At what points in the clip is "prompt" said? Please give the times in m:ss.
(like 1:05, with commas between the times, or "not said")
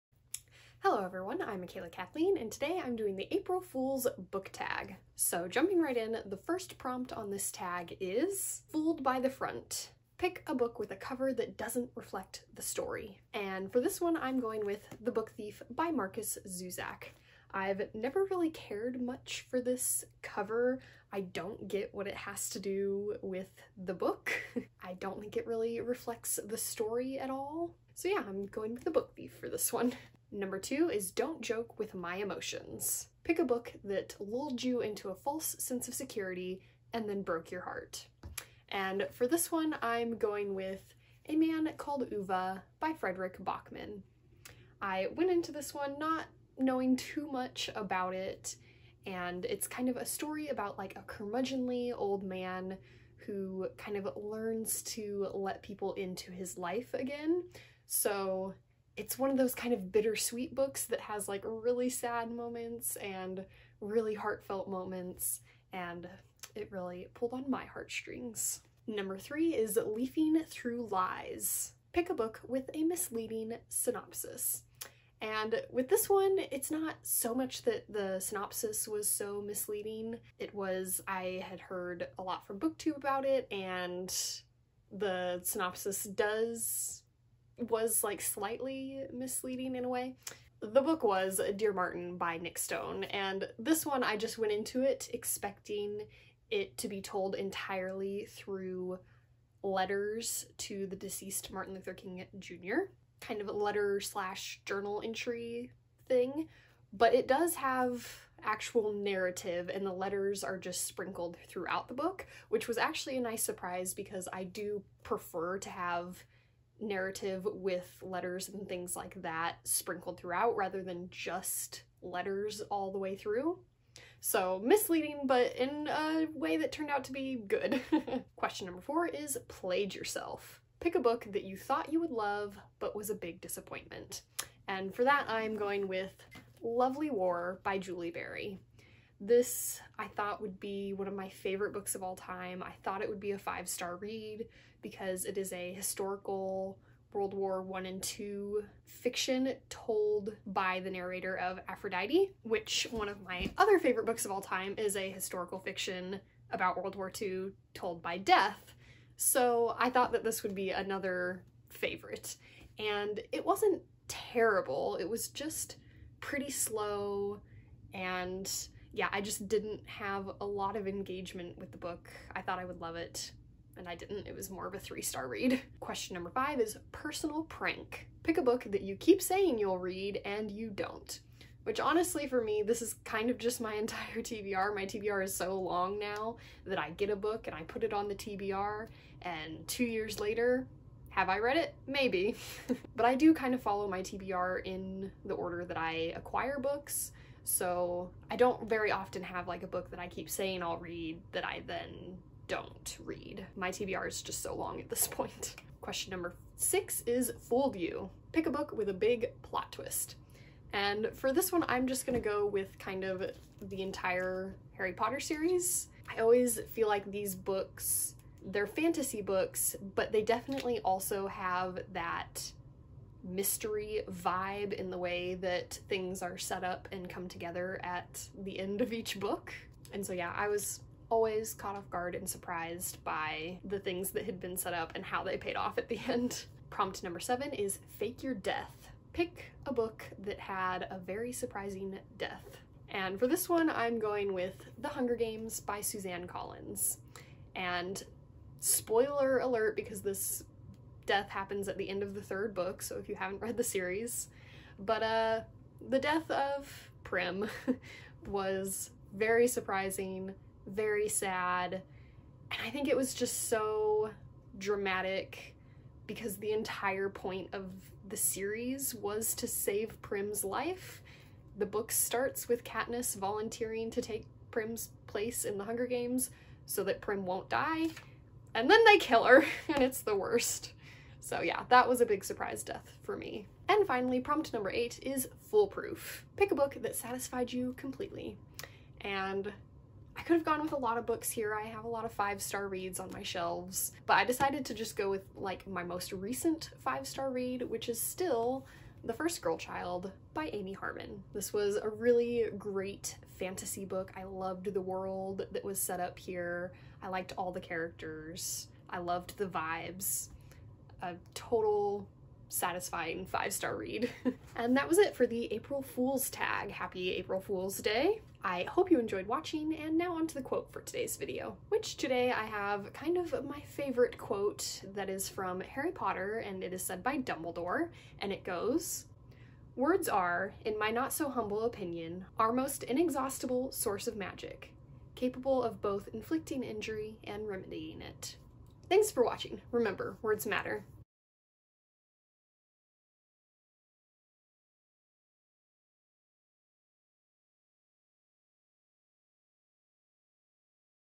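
0:06, 3:56, 4:44.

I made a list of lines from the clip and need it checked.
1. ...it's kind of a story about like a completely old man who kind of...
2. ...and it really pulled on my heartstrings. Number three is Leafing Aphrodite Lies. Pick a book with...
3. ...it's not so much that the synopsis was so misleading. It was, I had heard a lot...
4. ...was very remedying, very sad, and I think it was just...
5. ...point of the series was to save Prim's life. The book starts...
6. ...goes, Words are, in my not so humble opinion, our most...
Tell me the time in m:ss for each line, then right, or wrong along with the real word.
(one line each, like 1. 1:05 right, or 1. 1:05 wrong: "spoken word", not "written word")
1. 0:49 wrong: "curmudgeonly", not "completely"
2. 1:05 wrong: "Through", not "Aphrodite"
3. 1:16 right
4. 4:18 wrong: "surprising", not "remedying"
5. 4:27 right
6. 5:28 right.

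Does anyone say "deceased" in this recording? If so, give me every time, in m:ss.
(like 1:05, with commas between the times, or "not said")
1:40.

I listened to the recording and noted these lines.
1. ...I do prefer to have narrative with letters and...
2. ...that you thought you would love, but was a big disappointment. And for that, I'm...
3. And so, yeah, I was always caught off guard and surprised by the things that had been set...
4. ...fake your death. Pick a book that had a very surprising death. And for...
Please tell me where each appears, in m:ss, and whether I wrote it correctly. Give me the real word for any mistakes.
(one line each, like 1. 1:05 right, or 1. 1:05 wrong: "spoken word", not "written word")
1. 1:54 right
2. 2:11 right
3. 3:49 right
4. 3:57 right.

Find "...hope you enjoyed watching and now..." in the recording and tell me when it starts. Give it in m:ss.
5:18.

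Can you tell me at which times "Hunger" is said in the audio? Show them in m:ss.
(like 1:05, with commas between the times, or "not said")
4:04, 4:35.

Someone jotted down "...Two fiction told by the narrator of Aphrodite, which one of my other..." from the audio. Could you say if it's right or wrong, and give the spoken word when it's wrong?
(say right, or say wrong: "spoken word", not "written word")
right.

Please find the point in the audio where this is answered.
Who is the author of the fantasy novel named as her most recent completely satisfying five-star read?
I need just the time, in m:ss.
5:00.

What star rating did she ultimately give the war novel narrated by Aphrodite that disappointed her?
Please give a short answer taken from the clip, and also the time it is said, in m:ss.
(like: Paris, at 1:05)
3 stars, at 2:54.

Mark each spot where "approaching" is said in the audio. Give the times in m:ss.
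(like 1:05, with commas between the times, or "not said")
not said.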